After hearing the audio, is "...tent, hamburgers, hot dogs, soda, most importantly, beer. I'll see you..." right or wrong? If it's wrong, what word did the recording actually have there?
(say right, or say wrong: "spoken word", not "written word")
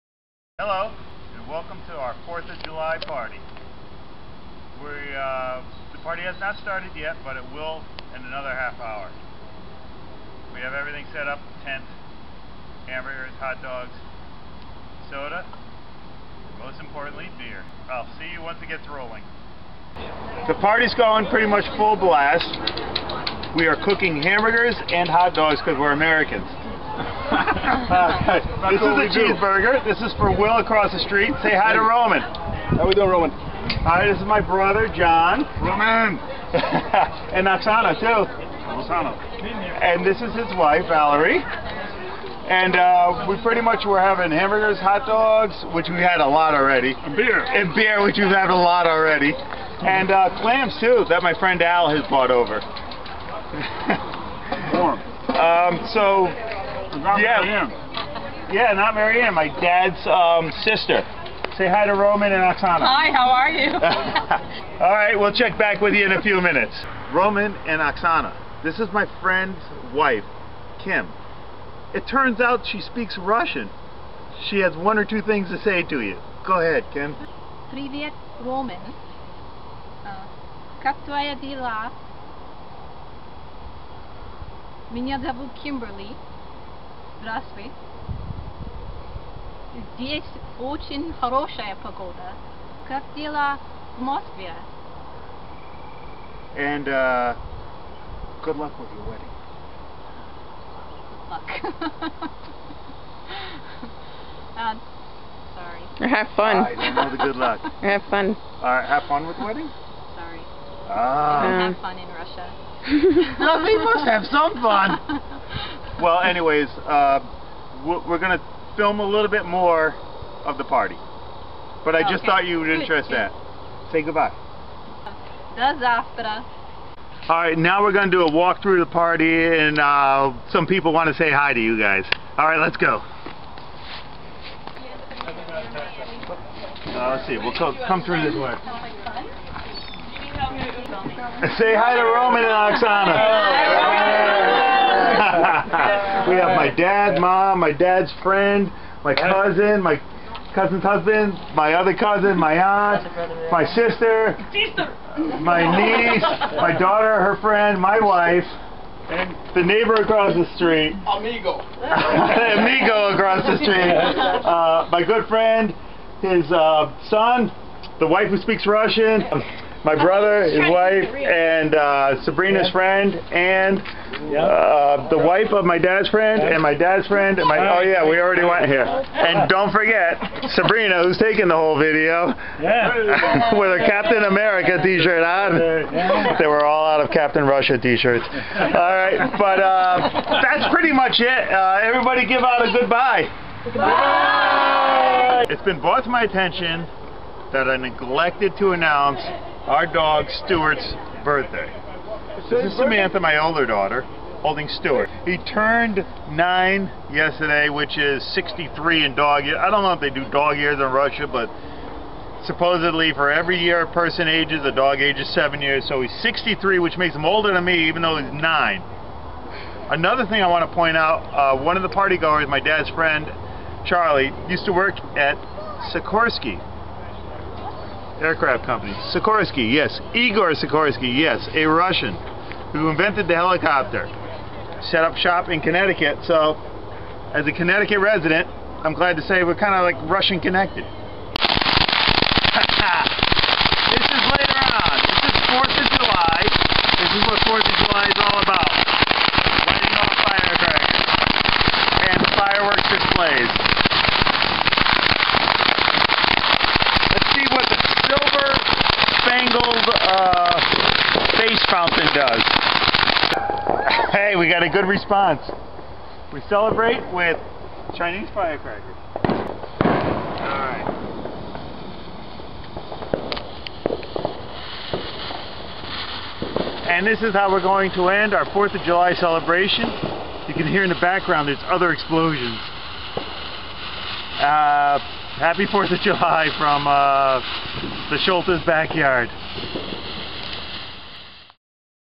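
right.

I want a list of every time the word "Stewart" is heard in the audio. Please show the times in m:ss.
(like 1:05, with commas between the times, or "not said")
3:20, 3:24.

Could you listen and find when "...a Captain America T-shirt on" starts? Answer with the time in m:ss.
3:03.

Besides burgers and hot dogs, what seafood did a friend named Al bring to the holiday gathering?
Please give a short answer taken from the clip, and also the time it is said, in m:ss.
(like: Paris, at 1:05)
Clams, at 0:50.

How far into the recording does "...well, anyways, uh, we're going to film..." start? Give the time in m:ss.
1:56.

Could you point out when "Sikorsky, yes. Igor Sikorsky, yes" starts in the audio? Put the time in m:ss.
3:49.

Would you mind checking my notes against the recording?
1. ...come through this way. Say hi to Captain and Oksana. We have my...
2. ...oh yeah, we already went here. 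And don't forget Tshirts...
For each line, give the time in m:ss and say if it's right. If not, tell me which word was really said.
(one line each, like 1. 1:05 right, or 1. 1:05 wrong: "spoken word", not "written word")
1. 2:17 wrong: "Roman", not "Captain"
2. 2:57 wrong: "Sabrina", not "Tshirts".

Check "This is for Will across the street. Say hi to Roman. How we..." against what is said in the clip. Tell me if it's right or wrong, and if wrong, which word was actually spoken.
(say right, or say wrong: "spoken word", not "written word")
right.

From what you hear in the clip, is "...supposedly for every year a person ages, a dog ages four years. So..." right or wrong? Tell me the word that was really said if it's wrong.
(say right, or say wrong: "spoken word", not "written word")
wrong: "seven", not "four".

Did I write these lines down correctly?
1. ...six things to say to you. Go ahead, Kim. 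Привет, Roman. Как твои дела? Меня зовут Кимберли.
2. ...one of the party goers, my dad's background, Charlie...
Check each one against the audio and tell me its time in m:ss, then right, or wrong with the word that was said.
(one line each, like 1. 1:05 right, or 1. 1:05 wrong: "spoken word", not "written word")
1. 1:15 wrong: "two", not "six"
2. 3:41 wrong: "friend", not "background".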